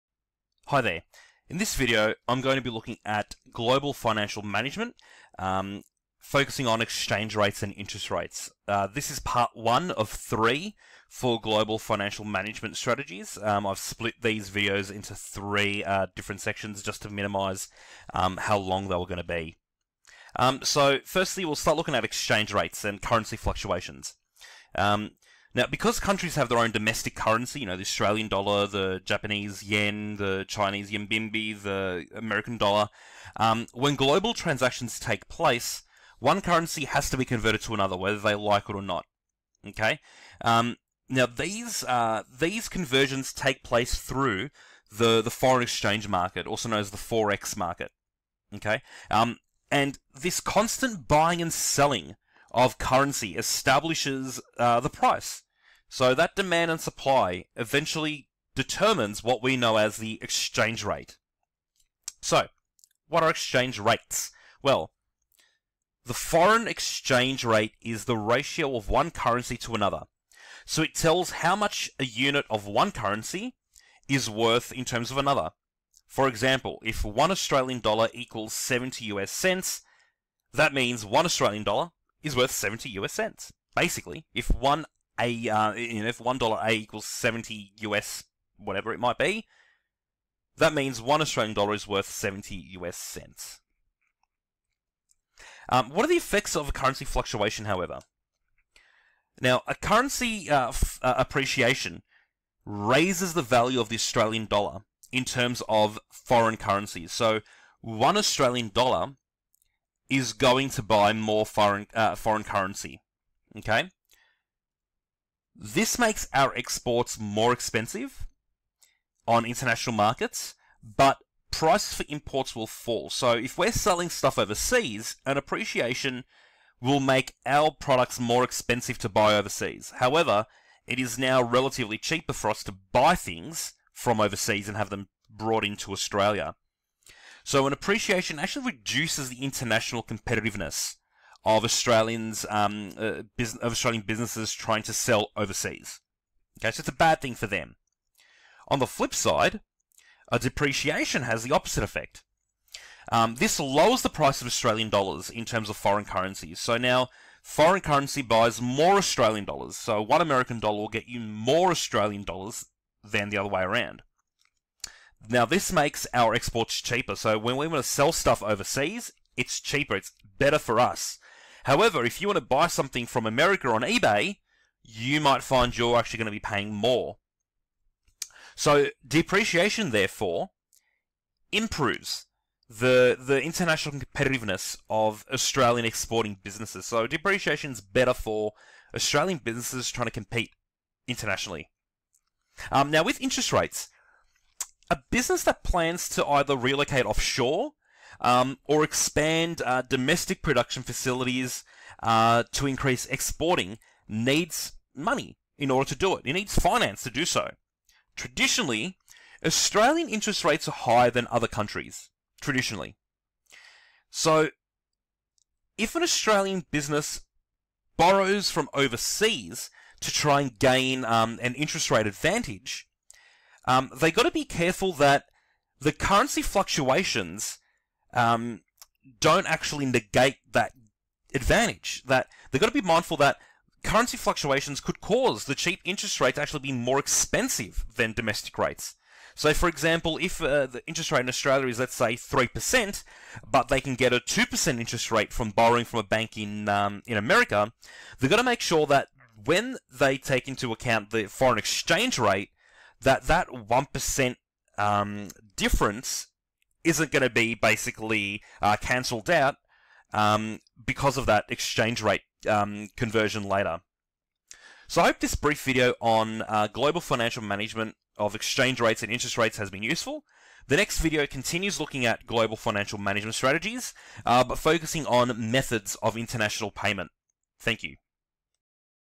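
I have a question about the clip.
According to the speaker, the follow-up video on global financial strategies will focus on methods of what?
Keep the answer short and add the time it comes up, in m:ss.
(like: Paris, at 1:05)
international payment, at 4:36.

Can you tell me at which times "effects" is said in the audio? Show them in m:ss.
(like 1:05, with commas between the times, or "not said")
1:36, 2:31.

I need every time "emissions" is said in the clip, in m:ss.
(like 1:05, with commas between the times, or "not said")
not said.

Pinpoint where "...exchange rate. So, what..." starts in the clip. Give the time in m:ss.
1:00.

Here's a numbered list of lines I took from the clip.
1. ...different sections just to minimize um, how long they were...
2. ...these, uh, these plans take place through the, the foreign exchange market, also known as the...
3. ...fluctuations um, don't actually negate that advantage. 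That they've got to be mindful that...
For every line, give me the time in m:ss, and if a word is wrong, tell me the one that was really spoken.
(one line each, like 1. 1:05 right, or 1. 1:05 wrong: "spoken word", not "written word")
1. 0:16 right
2. 0:41 wrong: "conversions", not "plans"
3. 3:46 right.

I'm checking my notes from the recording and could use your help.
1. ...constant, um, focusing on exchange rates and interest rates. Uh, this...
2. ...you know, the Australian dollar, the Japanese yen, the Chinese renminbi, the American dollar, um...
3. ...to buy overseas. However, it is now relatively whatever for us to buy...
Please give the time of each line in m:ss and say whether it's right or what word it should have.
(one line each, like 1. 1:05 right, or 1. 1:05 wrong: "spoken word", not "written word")
1. 0:04 wrong: "management", not "constant"
2. 0:27 right
3. 2:08 wrong: "cheaper", not "whatever".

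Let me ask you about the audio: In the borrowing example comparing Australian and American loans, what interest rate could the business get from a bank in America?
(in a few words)
2%.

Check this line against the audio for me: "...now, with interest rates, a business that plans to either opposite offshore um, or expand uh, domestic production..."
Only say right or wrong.
wrong.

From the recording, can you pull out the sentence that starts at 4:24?
So I hope this brief video on uh, global financial management of exchange rates and interest rates has been useful.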